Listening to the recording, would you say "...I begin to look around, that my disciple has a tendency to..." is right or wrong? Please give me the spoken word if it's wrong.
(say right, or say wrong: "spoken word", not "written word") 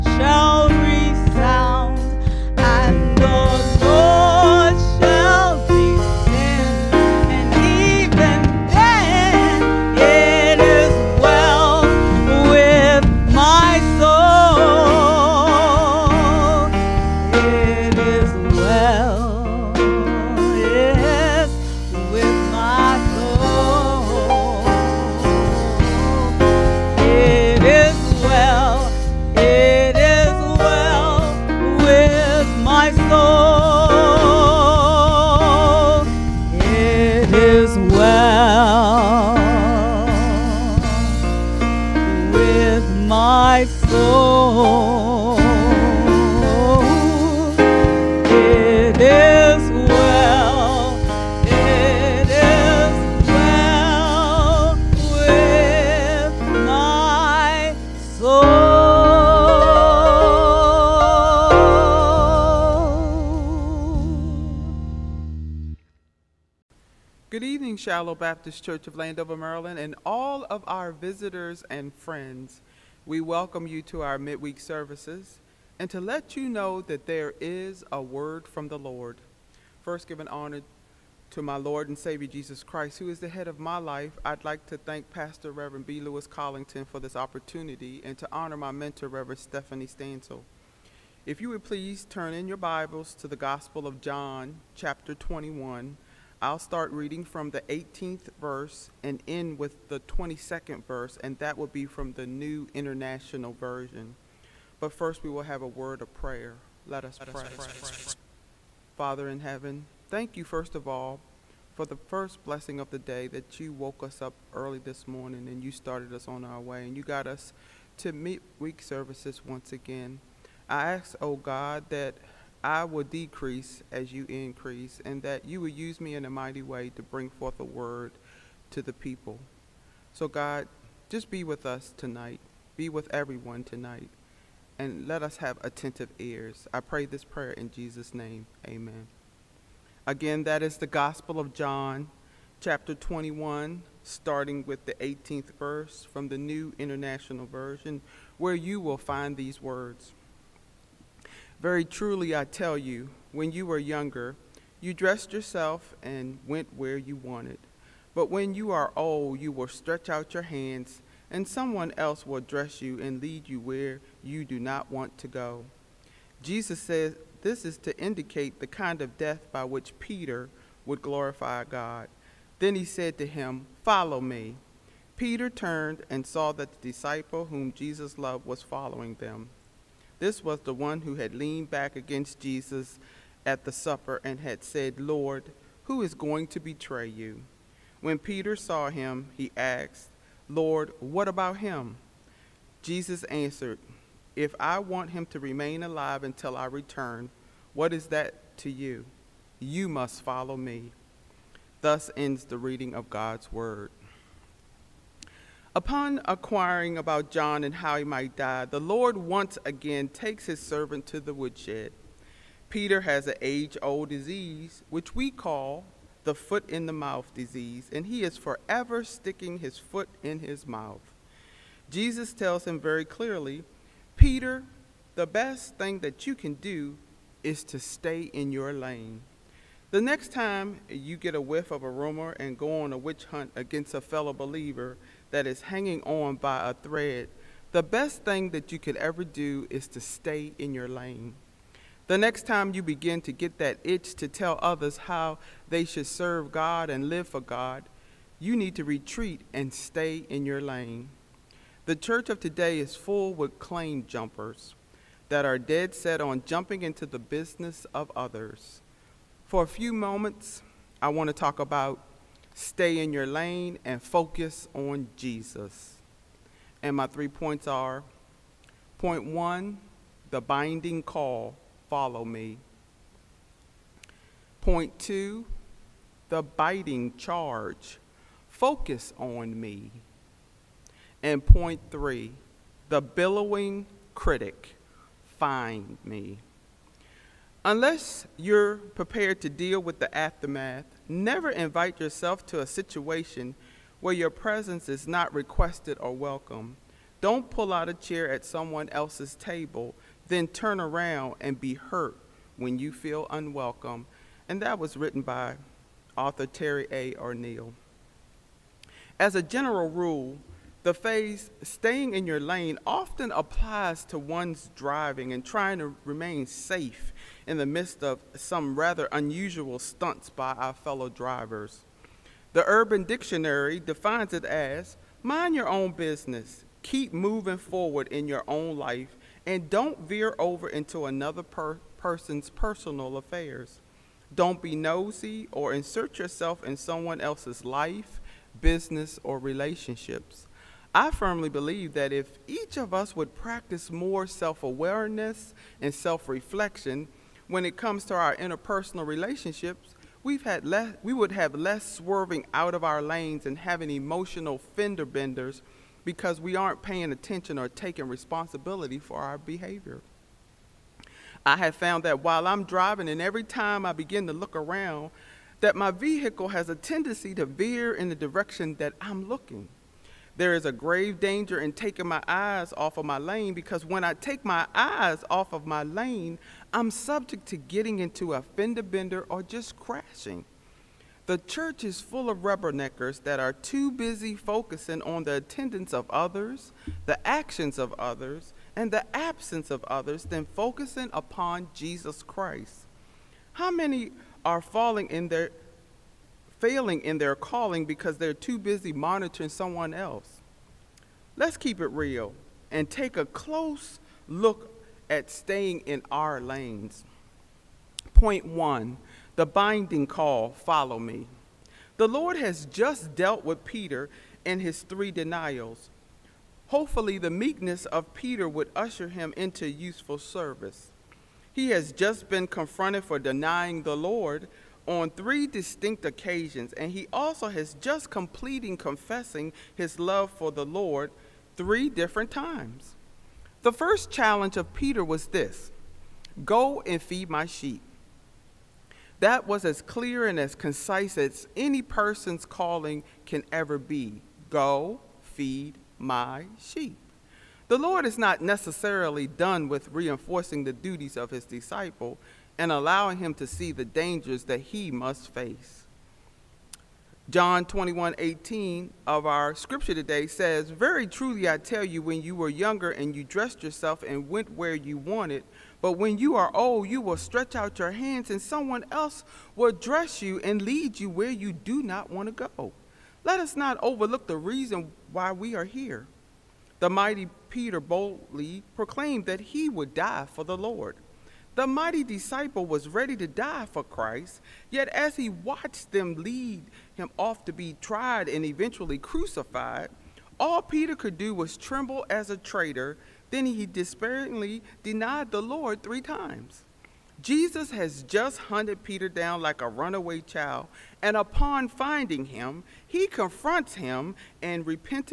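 wrong: "vehicle", not "disciple".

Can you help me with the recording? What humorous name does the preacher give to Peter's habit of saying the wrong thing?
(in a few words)
foot in the mouth disease.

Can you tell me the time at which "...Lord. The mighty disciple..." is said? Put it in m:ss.
8:00.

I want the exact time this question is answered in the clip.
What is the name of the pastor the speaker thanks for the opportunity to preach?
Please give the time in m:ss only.
1:25.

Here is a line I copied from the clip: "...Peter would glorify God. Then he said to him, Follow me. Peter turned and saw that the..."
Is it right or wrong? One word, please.
right.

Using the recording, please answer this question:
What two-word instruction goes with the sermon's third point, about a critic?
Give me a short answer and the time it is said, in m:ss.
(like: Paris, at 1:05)
find me, at 4:45.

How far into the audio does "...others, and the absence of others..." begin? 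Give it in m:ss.
6:27.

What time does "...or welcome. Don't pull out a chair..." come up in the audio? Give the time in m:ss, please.
4:55.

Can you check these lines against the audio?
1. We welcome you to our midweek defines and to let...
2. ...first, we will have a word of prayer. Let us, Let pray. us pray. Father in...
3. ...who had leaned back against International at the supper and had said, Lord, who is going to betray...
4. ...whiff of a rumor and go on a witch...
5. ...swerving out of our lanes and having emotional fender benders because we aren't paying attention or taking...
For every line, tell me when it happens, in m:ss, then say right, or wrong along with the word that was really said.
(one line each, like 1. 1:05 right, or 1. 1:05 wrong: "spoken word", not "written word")
1. 1:13 wrong: "services", not "defines"
2. 1:44 right
3. 3:01 wrong: "Jesus", not "International"
4. 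3:51 right
5. 5:51 right.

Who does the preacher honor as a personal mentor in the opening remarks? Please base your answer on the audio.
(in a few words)
Stephanie Stansel.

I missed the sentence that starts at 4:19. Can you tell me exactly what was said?
For a few moments, I want to talk about stay in your lane, and focus on Jesus.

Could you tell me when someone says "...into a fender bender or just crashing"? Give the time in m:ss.
6:17.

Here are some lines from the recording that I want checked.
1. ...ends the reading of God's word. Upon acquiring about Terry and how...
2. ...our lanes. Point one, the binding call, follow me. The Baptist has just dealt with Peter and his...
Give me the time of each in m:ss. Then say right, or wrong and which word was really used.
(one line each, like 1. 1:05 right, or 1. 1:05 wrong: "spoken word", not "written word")
1. 3:22 wrong: "John", not "Terry"
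2. 6:46 wrong: "Lord", not "Baptist".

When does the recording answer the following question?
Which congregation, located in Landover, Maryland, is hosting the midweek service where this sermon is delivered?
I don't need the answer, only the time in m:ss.
1:07.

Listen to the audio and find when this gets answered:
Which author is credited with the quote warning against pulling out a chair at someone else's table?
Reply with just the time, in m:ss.
5:06.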